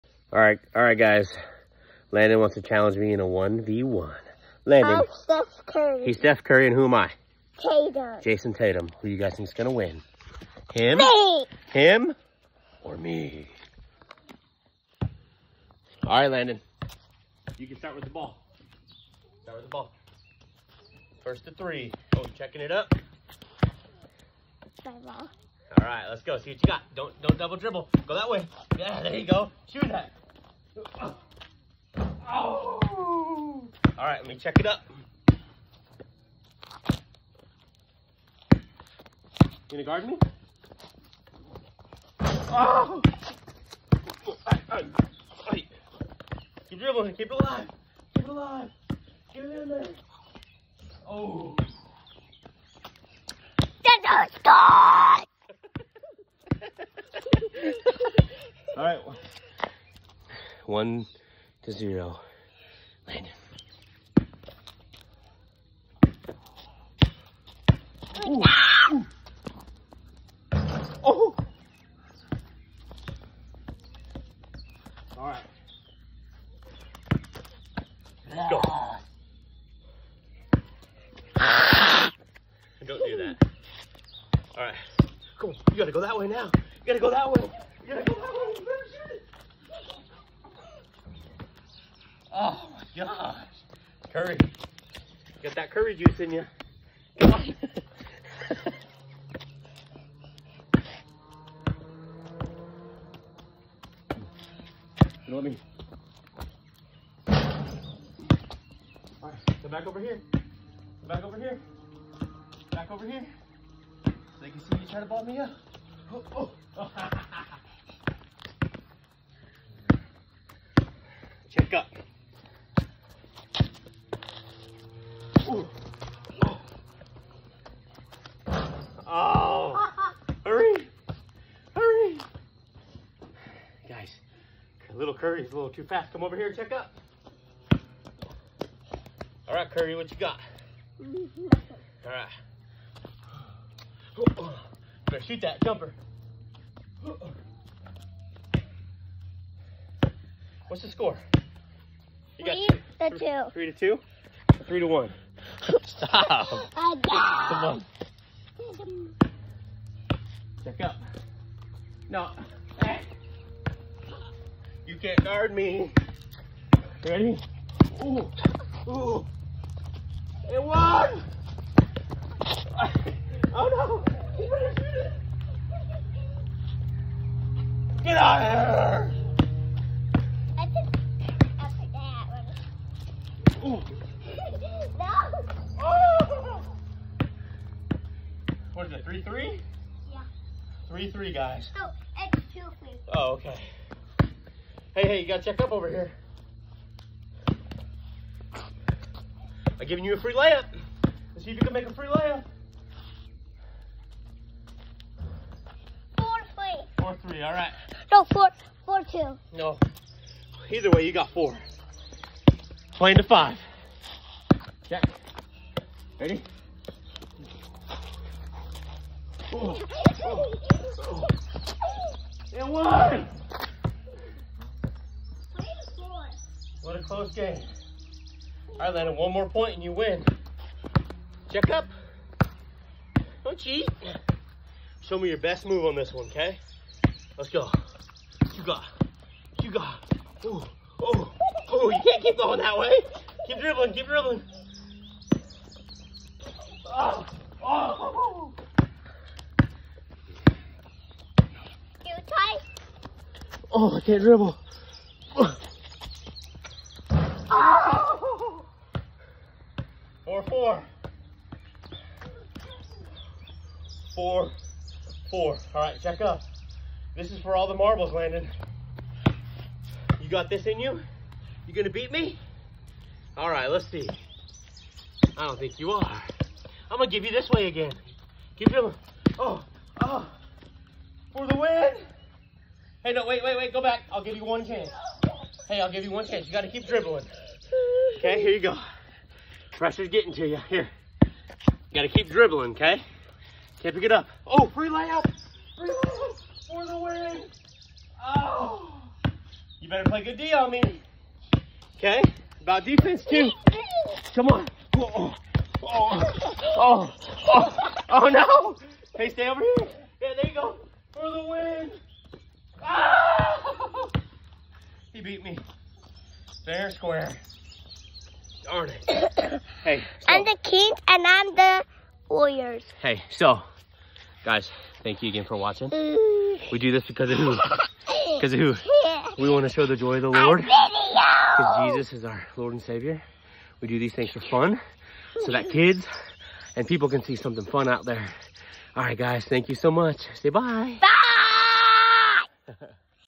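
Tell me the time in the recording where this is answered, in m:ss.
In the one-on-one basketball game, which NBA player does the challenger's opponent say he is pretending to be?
0:08.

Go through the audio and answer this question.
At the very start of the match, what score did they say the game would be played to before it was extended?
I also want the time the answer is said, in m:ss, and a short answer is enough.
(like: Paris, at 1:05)
3, at 0:21.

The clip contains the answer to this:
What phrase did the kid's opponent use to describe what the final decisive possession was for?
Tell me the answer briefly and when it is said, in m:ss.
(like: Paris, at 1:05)
all the marbles, at 4:27.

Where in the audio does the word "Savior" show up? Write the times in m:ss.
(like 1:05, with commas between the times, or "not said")
5:32.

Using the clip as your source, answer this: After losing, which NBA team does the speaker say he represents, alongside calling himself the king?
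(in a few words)
Warriors.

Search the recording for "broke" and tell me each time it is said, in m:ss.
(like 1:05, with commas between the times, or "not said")
not said.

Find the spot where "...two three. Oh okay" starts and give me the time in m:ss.
3:12.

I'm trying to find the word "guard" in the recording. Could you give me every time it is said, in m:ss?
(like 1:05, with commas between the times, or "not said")
0:39, 2:45.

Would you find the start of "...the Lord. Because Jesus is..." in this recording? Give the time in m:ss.
5:30.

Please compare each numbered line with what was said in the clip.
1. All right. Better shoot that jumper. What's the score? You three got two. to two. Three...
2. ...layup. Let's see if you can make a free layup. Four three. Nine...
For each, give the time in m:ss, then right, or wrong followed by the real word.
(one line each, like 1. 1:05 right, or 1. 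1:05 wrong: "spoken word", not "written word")
1. 2:20 right
2. 3:20 wrong: "Four", not "Nine".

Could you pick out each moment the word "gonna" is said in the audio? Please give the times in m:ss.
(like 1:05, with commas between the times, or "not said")
0:39, 4:31, 4:36.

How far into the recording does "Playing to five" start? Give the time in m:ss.
3:32.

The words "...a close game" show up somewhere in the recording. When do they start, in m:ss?
3:46.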